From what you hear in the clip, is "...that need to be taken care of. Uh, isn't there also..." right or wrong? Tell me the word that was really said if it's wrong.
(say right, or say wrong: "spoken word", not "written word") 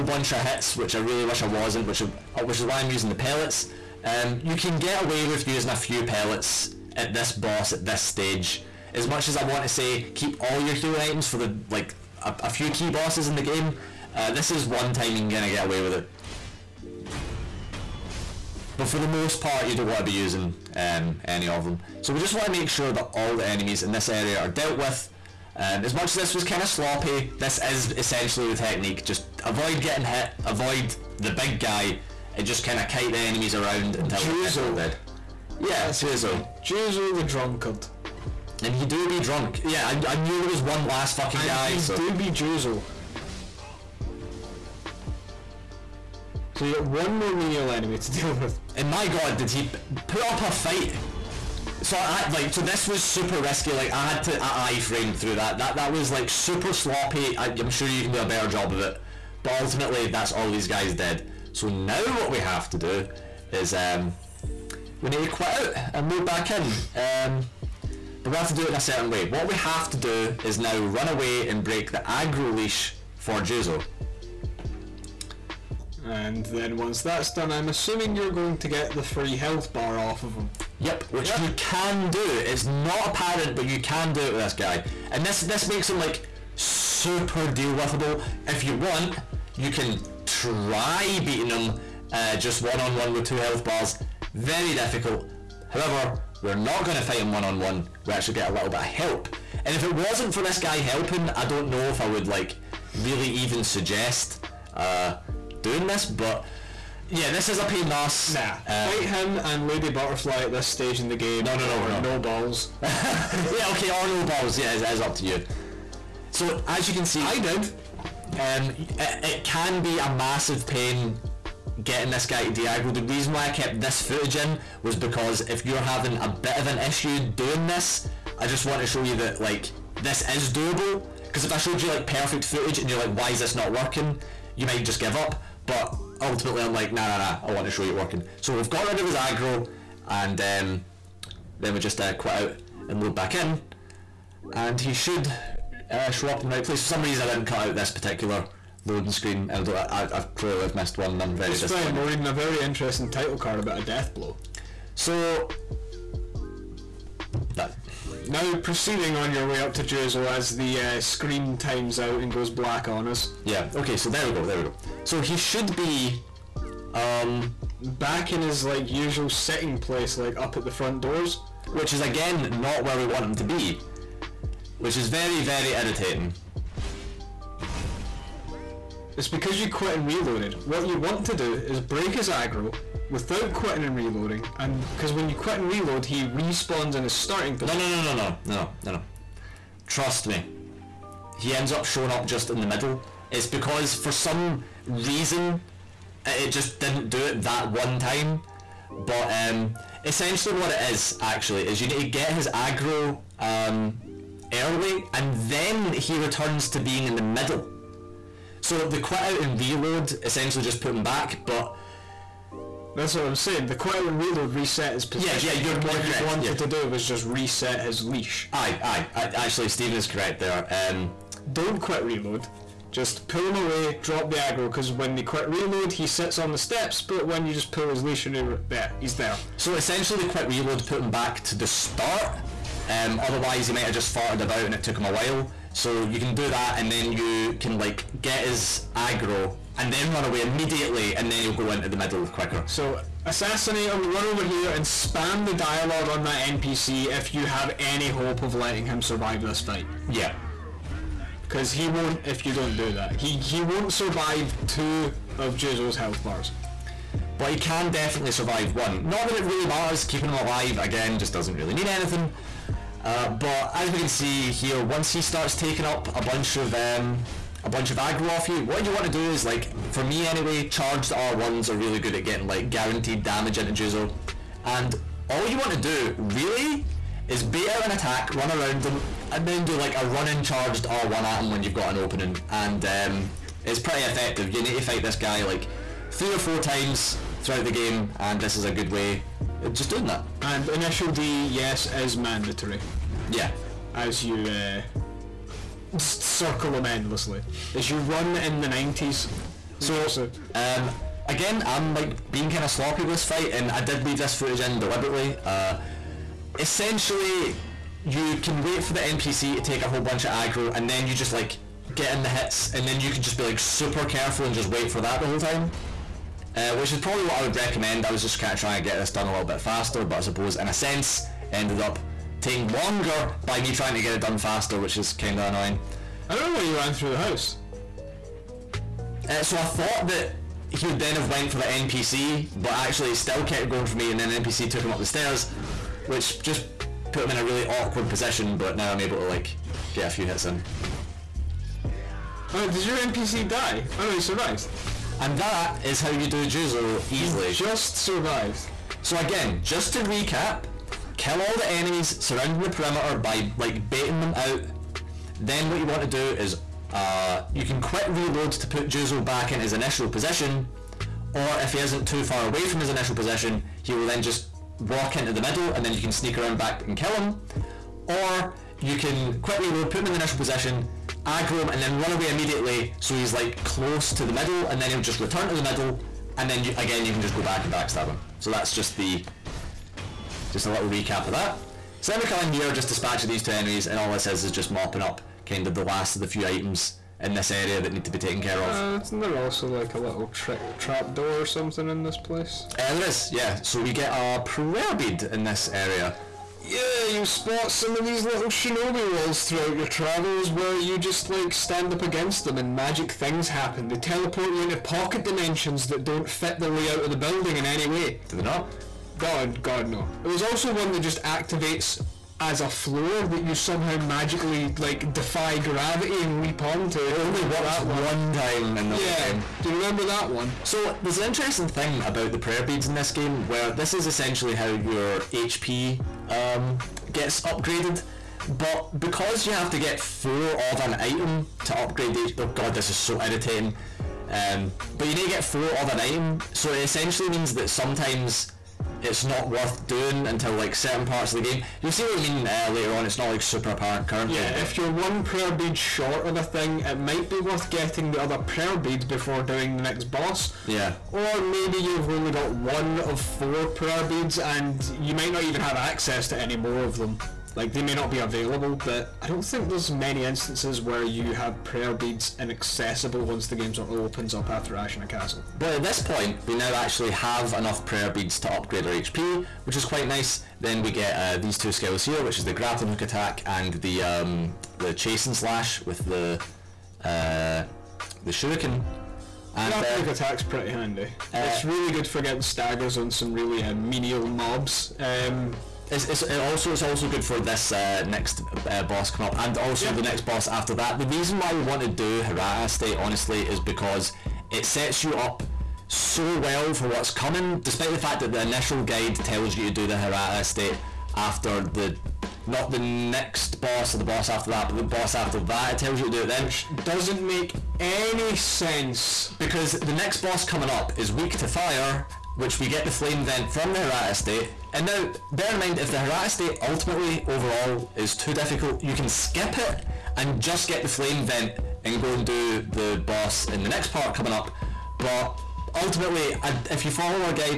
right.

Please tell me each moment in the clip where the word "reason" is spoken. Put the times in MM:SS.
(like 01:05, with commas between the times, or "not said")
02:03, 02:27, 03:14, 08:11.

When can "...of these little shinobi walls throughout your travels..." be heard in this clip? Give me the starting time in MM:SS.
06:37.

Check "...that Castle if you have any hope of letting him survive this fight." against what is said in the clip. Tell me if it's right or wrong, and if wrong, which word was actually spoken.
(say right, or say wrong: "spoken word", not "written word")
wrong: "NPC", not "Castle".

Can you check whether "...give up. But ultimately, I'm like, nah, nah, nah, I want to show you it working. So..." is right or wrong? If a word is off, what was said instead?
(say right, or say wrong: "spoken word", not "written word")
right.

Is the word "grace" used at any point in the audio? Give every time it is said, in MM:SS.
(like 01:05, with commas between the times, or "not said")
not said.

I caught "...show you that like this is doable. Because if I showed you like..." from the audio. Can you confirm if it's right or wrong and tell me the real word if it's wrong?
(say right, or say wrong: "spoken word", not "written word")
right.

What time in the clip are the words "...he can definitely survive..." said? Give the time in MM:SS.
04:17.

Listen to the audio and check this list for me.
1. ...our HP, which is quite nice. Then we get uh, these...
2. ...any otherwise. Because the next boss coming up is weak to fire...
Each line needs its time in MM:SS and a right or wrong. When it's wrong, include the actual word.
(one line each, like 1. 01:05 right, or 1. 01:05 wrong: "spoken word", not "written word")
1. 07:48 right
2. 08:27 wrong: "sense", not "otherwise".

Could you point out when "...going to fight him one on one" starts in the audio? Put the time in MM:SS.
01:36.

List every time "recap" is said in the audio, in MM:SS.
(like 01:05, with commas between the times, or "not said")
05:50, 06:20.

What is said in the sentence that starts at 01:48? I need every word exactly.
Nah, um, fight him and Lady Butterfly at this stage in the game.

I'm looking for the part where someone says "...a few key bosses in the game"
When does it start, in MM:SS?
00:12.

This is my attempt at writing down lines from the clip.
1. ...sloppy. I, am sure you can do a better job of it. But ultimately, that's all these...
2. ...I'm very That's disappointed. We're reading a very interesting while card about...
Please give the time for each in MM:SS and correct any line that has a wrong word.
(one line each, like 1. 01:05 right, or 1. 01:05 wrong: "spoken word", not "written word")
1. 00:56 right
2. 02:31 wrong: "title", not "while".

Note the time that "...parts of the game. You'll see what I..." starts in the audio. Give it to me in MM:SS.
07:21.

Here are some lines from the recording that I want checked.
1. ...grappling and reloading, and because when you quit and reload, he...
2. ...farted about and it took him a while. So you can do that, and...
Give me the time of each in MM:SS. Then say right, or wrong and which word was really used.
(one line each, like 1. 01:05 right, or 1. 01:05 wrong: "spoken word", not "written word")
1. 03:03 wrong: "quitting", not "grappling"
2. 03:54 right.